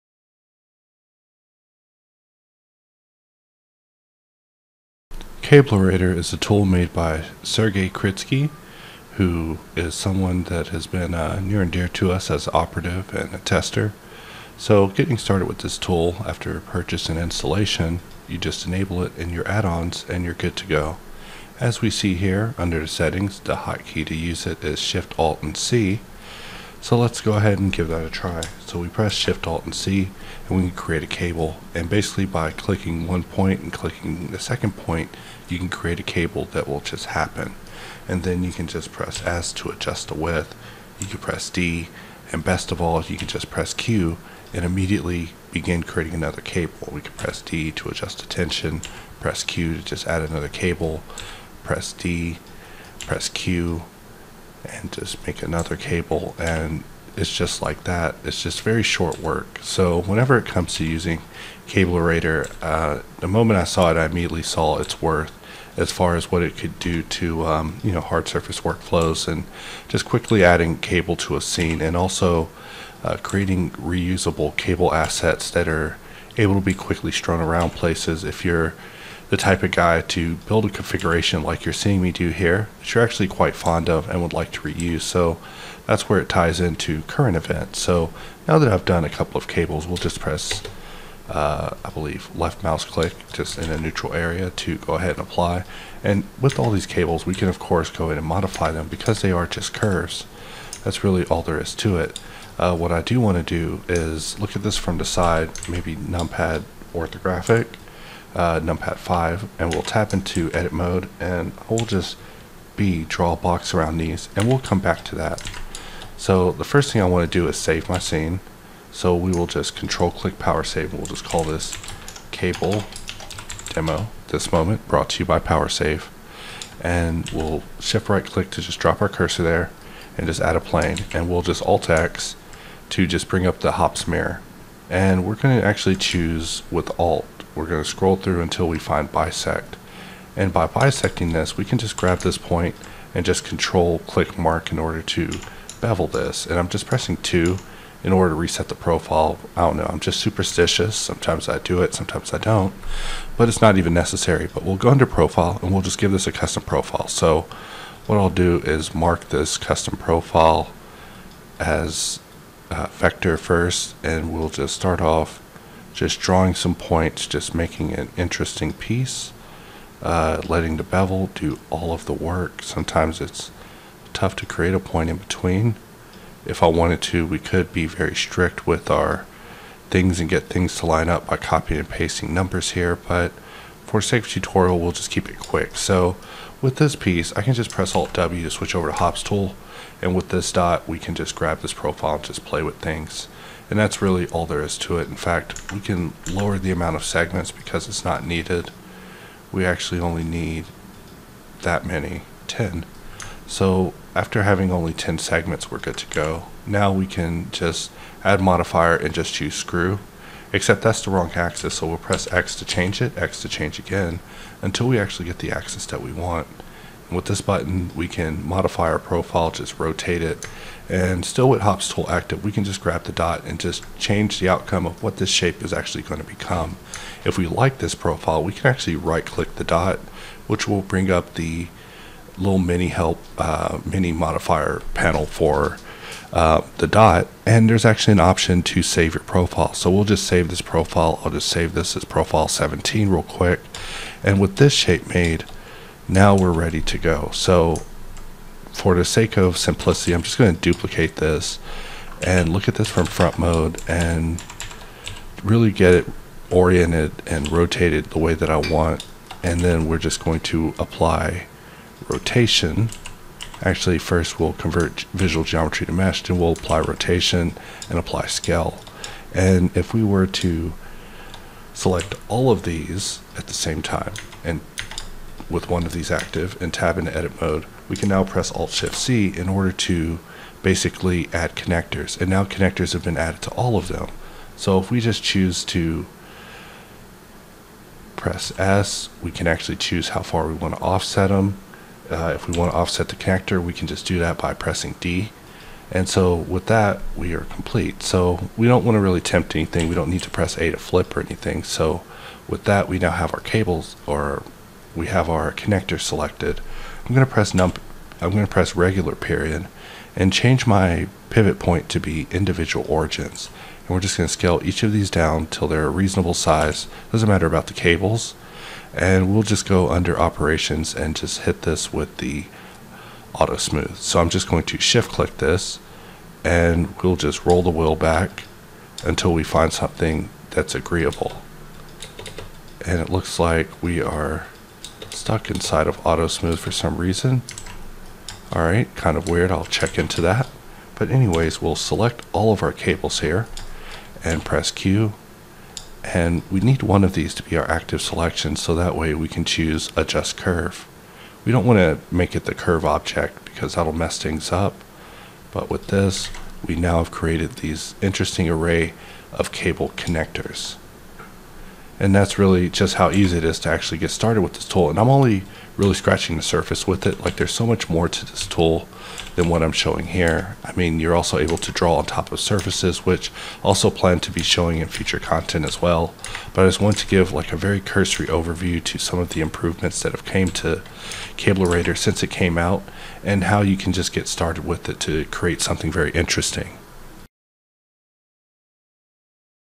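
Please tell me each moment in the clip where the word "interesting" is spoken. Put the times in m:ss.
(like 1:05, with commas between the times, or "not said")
2:48, 5:58, 6:26.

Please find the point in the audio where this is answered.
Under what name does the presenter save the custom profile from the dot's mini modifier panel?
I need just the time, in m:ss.
4:02.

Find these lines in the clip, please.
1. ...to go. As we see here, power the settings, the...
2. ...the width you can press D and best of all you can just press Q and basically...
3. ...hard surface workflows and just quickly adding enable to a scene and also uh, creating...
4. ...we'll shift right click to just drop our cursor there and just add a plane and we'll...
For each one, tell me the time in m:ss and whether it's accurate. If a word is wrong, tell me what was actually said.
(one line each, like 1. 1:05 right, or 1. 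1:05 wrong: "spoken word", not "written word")
1. 0:20 wrong: "under", not "power"
2. 0:40 wrong: "immediately", not "basically"
3. 1:08 wrong: "cable", not "enable"
4. 2:07 right.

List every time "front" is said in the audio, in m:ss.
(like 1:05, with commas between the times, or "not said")
4:13.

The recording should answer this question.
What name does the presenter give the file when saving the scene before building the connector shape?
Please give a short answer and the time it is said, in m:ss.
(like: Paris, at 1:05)
cable demo, at 2:02.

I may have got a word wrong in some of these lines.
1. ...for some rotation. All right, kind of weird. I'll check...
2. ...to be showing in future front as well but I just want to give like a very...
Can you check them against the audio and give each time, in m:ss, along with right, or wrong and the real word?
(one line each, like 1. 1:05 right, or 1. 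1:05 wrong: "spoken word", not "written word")
1. 5:36 wrong: "reason", not "rotation"
2. 6:14 wrong: "content", not "front".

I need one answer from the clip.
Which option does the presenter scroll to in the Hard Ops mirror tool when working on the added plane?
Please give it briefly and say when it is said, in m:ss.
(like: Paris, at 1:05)
bisect, at 2:19.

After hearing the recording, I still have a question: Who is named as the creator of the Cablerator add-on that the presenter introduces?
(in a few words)
Sergey Kritskiy.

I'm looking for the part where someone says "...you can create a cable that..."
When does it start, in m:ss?
0:35.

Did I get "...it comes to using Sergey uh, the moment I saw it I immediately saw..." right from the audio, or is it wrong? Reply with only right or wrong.
wrong.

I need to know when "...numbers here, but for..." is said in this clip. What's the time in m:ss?
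3:02.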